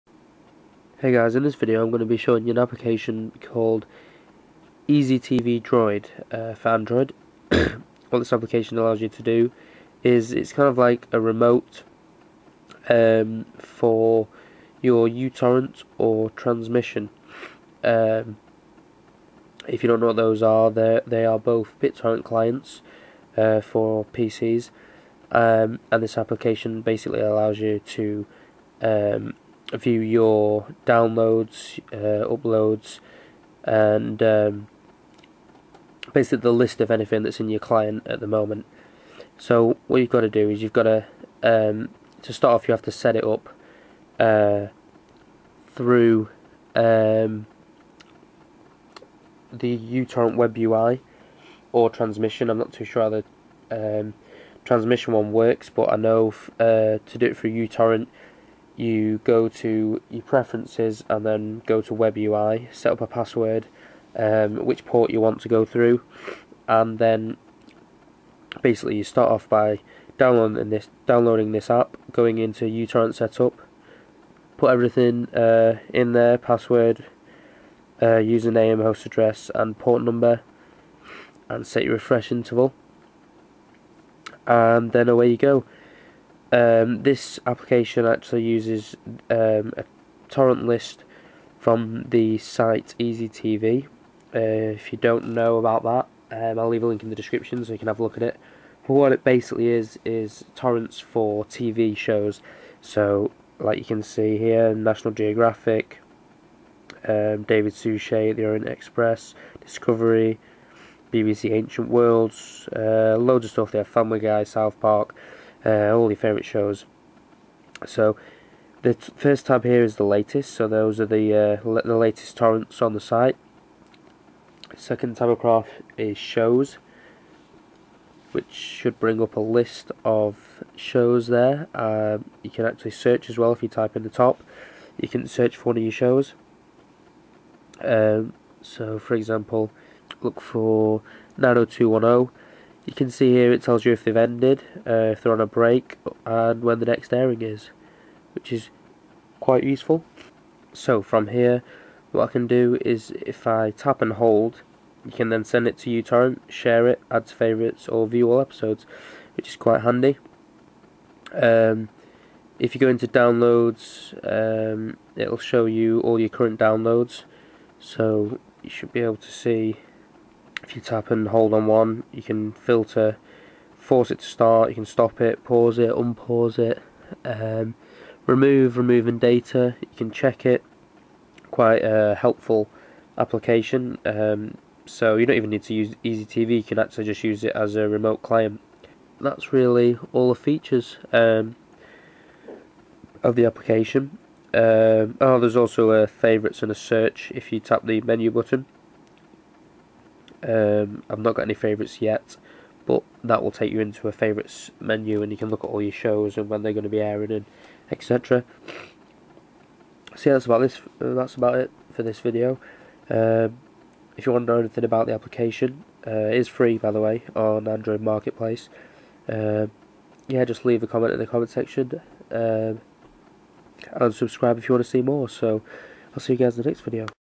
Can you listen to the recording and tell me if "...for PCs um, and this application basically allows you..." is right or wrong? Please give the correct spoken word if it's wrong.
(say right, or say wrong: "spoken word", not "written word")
right.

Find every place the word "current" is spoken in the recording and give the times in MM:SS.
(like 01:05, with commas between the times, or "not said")
02:46.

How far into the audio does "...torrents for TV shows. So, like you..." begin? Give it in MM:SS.
01:40.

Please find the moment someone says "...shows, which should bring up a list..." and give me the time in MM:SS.
02:06.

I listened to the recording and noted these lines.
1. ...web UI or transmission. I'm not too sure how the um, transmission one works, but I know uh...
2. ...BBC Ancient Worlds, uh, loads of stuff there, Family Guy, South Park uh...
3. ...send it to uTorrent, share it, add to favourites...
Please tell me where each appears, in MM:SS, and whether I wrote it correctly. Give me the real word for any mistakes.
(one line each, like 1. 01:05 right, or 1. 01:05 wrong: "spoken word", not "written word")
1. 00:50 right
2. 01:51 right
3. 02:35 right.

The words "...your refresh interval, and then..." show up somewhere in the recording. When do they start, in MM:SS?
01:21.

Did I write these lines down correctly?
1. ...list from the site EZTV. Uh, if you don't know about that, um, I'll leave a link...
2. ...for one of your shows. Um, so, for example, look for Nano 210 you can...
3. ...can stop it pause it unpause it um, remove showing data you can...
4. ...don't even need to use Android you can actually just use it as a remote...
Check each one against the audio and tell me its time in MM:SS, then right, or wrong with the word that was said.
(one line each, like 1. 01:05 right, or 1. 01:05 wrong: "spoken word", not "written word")
1. 01:30 right
2. 02:15 right
3. 02:54 wrong: "removing", not "showing"
4. 03:05 wrong: "EZTV", not "Android".